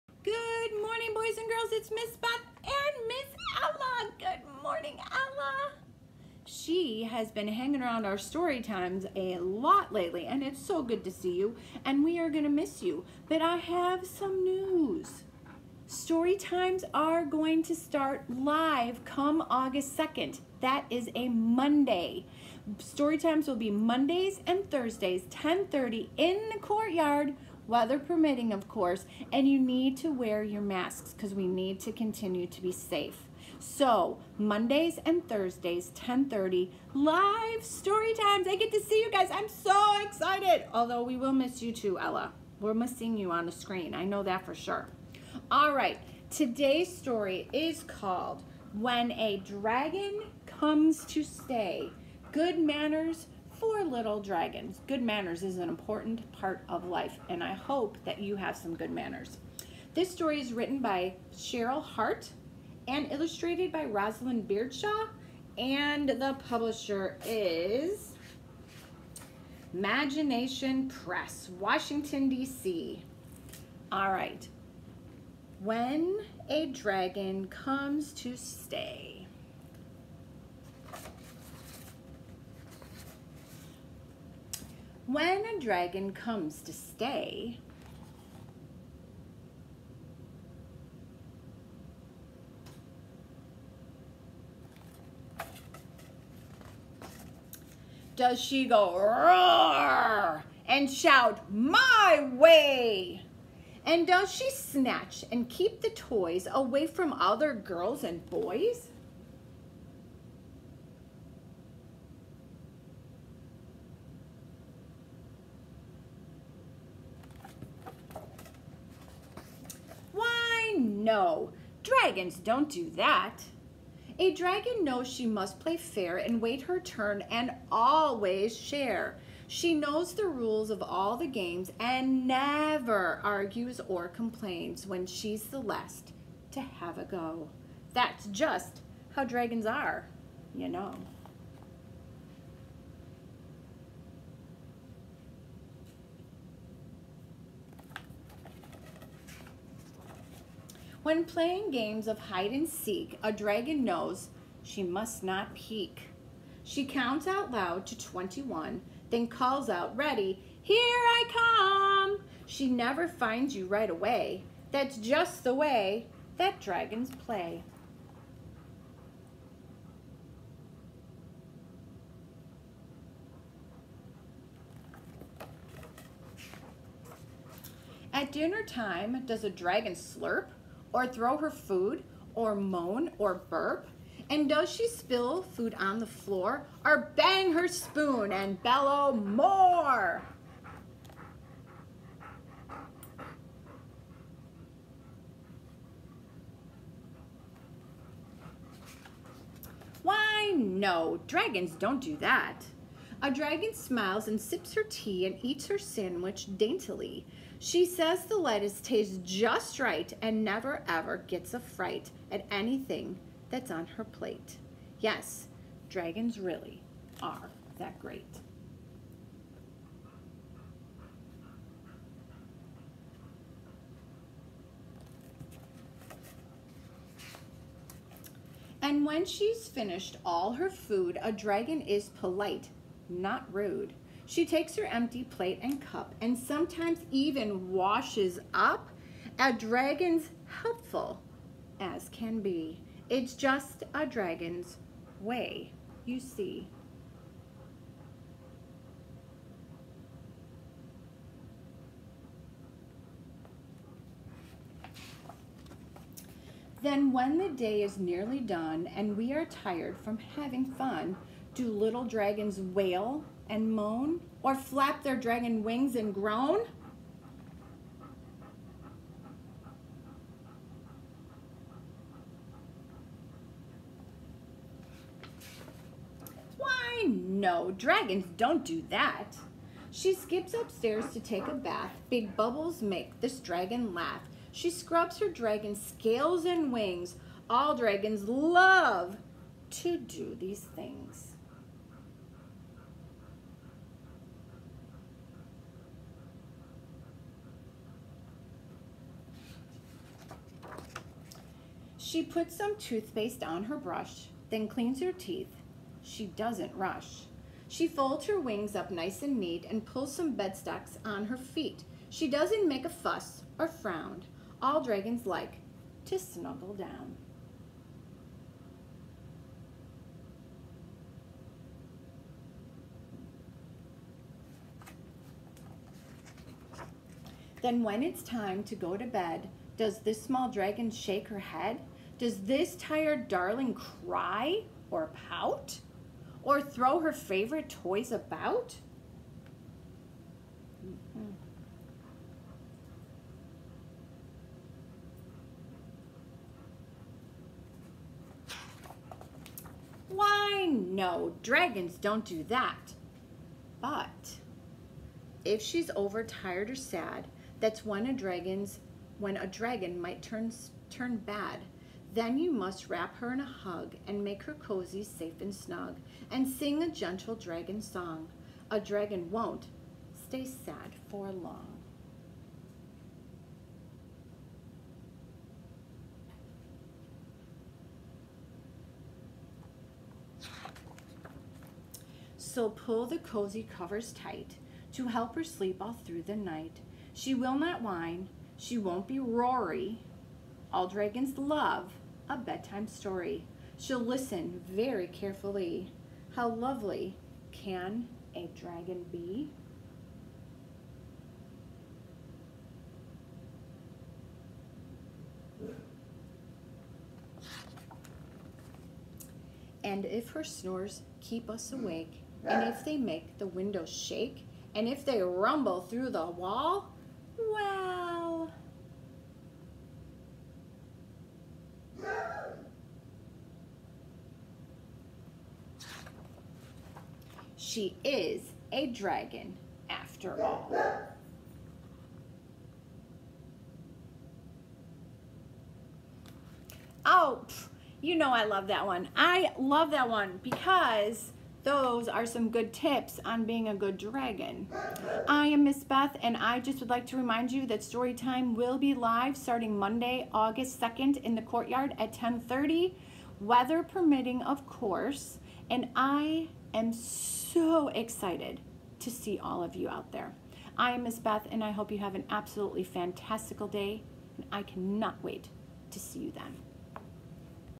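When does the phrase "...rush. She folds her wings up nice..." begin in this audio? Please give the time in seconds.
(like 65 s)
306 s.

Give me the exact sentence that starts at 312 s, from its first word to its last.
She doesn't make a fuss or frown.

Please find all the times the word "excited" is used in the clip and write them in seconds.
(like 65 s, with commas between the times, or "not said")
40 s, 457 s.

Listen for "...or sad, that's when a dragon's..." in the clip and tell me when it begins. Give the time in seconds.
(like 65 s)
356 s.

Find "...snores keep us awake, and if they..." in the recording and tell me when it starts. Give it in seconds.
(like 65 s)
410 s.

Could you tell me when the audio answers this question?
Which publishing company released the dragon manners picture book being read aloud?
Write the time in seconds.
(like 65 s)
69 s.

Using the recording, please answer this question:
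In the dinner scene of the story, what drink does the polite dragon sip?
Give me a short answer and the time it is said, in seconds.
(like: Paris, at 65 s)
tea, at 204 s.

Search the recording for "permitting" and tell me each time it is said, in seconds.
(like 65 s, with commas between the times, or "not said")
27 s, 453 s.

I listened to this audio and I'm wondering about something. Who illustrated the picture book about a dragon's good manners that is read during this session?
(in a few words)
Rosalind Beardshaw.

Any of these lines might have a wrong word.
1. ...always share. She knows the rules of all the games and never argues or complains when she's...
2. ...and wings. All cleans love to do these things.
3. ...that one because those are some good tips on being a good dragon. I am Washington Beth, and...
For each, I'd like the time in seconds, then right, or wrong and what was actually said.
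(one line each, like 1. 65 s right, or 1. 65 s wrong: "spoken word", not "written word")
1. 127 s right
2. 286 s wrong: "dragons", not "cleans"
3. 439 s wrong: "Miss", not "Washington".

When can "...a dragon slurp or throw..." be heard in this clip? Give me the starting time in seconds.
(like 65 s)
179 s.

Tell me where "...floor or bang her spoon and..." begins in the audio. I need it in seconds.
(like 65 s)
186 s.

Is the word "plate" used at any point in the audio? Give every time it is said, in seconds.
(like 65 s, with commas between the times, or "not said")
214 s, 235 s.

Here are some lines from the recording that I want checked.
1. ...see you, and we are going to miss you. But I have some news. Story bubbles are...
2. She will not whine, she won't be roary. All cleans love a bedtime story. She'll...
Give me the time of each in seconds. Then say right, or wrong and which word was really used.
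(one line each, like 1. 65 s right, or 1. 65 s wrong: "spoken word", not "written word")
1. 11 s wrong: "times", not "bubbles"
2. 387 s wrong: "dragons", not "cleans".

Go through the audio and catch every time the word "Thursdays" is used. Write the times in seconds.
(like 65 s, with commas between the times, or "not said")
24 s, 35 s.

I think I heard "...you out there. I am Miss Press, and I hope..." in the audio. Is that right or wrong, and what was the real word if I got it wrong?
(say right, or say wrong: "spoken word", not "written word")
wrong: "Beth", not "Press".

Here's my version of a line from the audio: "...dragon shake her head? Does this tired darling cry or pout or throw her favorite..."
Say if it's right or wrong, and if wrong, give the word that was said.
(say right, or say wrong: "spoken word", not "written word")
right.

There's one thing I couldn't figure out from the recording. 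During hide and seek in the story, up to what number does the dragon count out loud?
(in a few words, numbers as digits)
21.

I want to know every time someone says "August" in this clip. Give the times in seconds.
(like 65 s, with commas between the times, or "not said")
19 s, 450 s.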